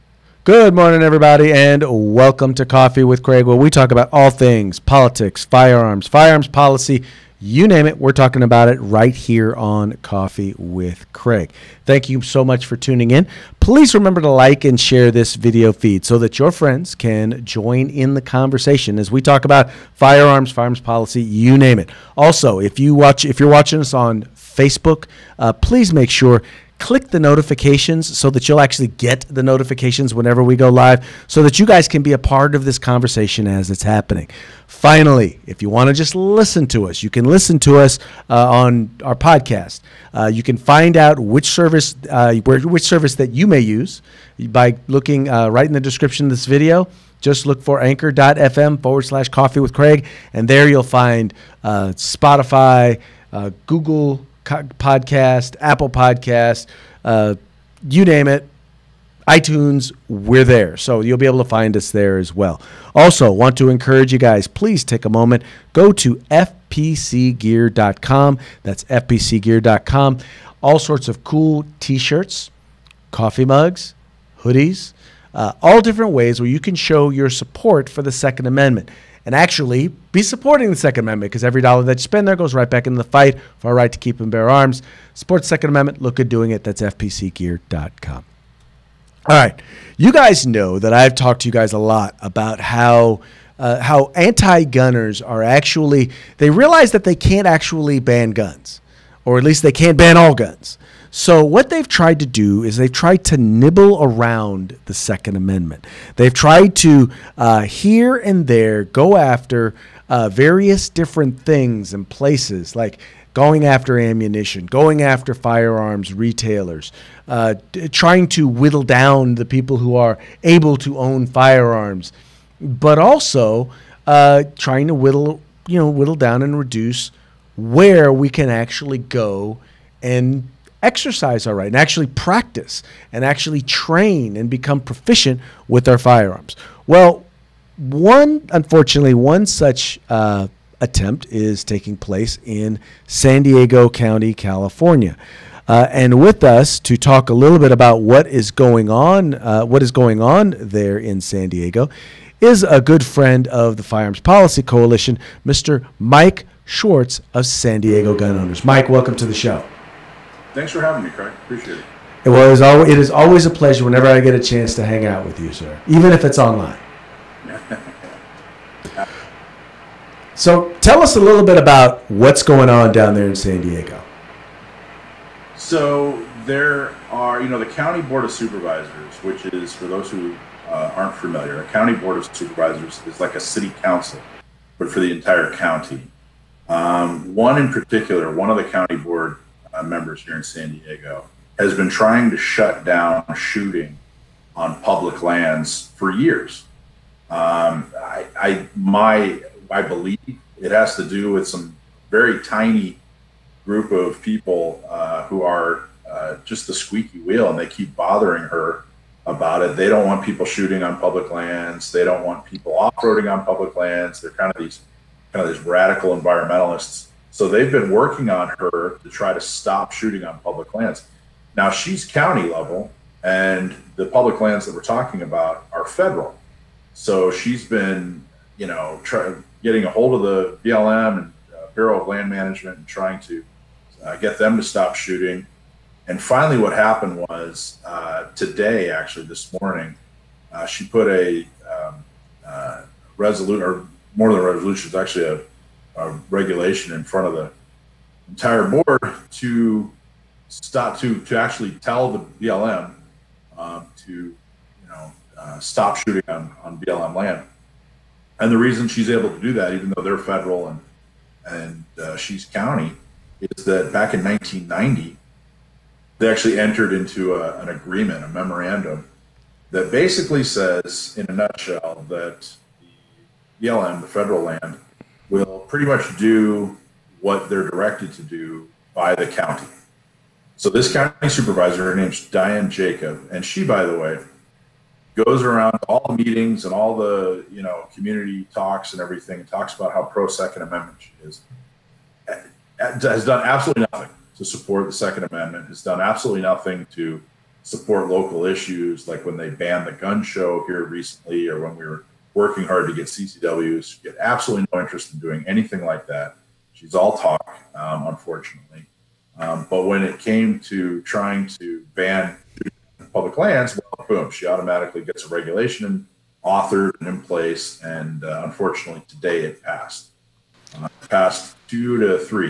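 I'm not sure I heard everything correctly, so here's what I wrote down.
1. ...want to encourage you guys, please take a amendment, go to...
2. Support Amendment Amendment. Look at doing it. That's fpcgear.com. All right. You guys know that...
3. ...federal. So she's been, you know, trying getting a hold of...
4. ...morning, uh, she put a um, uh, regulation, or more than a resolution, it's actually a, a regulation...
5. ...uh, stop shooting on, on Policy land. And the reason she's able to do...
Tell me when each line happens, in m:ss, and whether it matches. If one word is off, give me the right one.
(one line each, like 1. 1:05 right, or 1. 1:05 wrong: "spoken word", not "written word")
1. 1:03 wrong: "moment", not "amendment"
2. 1:25 wrong: "Second", not "Amendment"
3. 3:45 right
4. 3:59 wrong: "resolution", not "regulation"
5. 4:15 wrong: "BLM", not "Policy".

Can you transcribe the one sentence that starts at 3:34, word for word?
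They're kind of these kind of these radical environmentalists.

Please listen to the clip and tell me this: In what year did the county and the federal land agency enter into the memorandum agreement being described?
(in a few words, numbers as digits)
1990.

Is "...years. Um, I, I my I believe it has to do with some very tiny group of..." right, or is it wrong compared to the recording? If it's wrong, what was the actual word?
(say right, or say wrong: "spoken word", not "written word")
right.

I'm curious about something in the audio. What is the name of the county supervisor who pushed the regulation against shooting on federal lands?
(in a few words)
Diane Jacob.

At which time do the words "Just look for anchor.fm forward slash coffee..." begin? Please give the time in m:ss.
0:47.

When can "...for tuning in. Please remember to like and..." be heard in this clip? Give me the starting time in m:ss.
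0:12.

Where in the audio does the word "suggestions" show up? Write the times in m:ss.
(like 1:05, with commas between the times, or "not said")
not said.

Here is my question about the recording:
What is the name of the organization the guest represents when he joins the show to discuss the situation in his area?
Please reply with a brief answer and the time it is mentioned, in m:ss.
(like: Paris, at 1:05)
San Diego Gun Owners, at 2:37.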